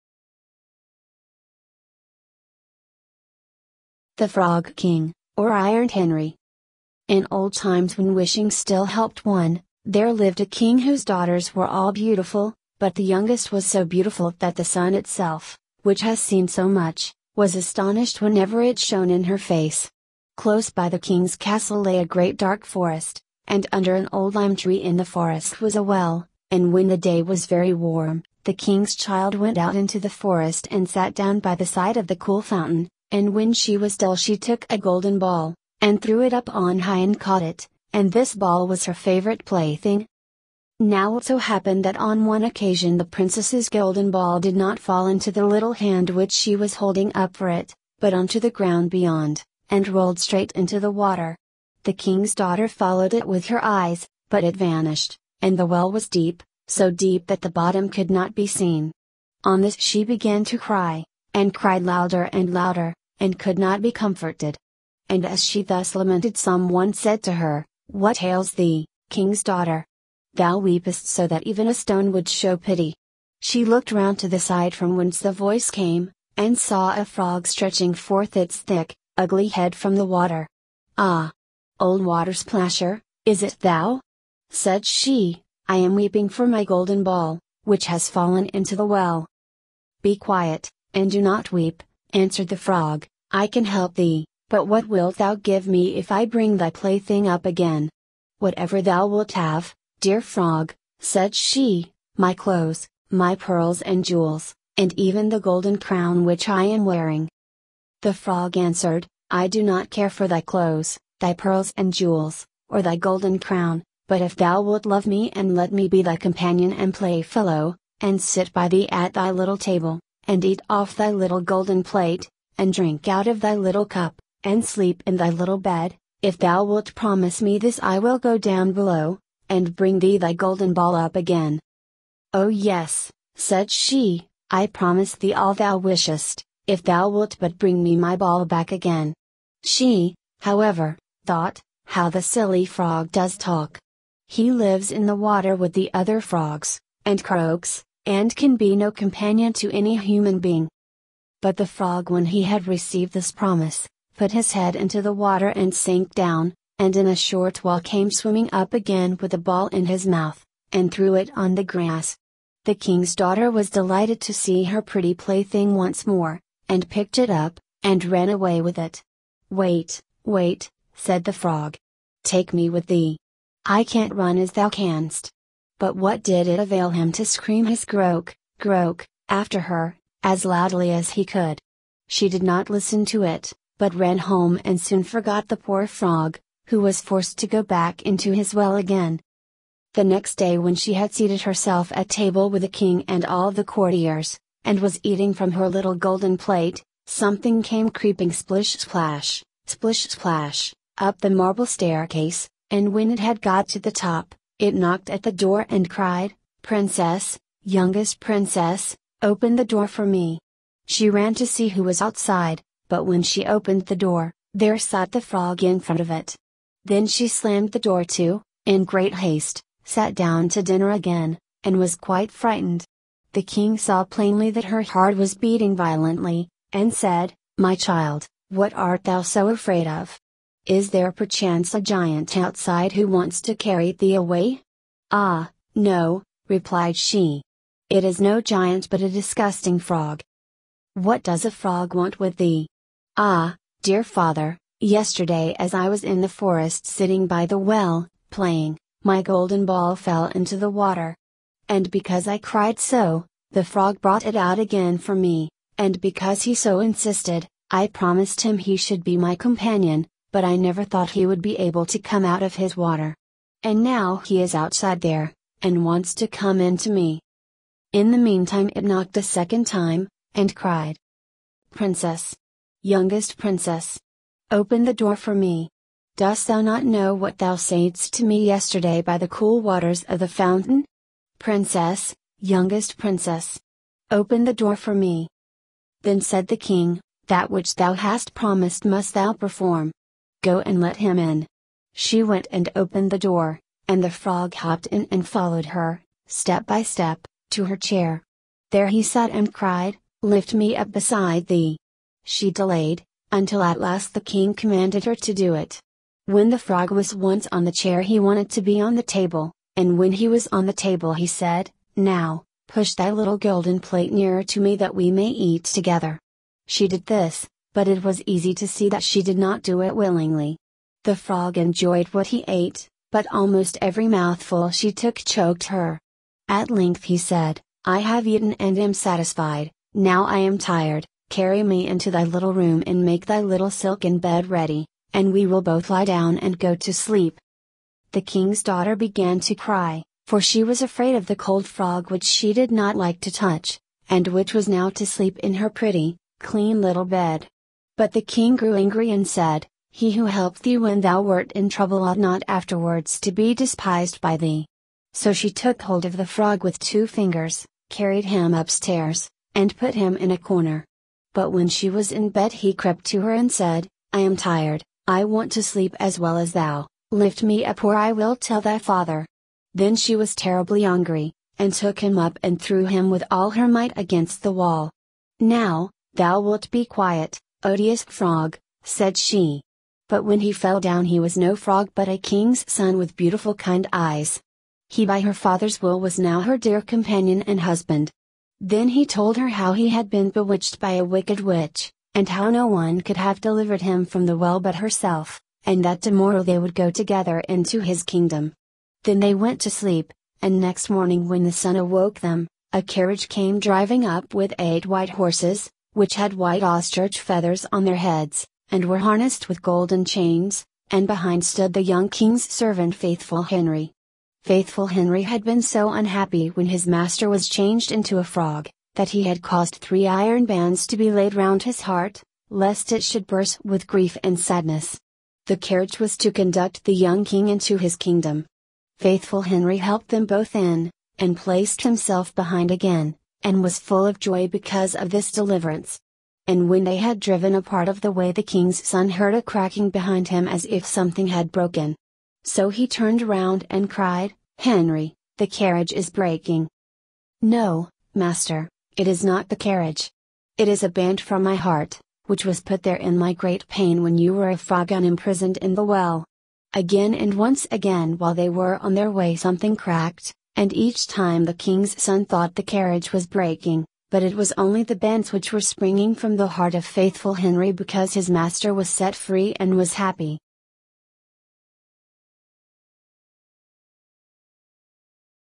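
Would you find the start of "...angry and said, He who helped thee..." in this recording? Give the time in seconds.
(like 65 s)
348 s.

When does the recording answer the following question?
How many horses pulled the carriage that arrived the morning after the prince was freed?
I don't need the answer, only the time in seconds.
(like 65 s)
404 s.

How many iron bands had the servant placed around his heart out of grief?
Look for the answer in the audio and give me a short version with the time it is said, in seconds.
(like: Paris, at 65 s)
3, at 419 s.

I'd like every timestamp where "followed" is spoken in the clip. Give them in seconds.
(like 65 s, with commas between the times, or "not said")
52 s, 295 s.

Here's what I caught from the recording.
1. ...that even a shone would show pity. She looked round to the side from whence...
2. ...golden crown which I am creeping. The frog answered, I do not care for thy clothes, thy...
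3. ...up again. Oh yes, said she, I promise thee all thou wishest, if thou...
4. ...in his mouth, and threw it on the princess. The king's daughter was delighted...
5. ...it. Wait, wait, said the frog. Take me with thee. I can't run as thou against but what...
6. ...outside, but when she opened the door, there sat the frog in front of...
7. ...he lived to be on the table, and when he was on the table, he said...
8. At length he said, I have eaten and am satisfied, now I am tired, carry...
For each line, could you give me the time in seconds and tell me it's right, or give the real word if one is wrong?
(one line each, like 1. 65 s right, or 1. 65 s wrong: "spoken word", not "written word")
1. 71 s wrong: "stone", not "shone"
2. 105 s wrong: "wearing", not "creeping"
3. 130 s right
4. 159 s wrong: "grass", not "princess"
5. 168 s wrong: "canst", not "against"
6. 211 s right
7. 308 s wrong: "wanted", not "lived"
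8. 326 s right.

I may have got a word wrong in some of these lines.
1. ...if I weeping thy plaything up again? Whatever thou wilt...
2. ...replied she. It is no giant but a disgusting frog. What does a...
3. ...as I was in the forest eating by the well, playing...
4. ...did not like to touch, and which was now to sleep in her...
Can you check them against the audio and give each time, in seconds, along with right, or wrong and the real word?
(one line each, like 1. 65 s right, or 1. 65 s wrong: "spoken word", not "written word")
1. 95 s wrong: "bring", not "weeping"
2. 236 s right
3. 245 s wrong: "sitting", not "eating"
4. 342 s right.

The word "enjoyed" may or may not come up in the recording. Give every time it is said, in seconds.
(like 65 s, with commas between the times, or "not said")
321 s.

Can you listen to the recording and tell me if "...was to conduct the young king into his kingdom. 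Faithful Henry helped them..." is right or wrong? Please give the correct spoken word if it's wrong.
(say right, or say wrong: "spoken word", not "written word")
right.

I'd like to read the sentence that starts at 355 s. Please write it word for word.
So she took hold of the frog with two fingers, carried him upstairs, and put him in a corner.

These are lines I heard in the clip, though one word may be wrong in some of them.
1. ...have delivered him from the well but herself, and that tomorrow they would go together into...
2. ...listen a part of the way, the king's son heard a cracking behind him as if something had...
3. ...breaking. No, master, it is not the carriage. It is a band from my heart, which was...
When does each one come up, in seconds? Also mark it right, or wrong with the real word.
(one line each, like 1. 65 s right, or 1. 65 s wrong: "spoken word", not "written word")
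1. 393 s right
2. 437 s wrong: "driven", not "listen"
3. 446 s right.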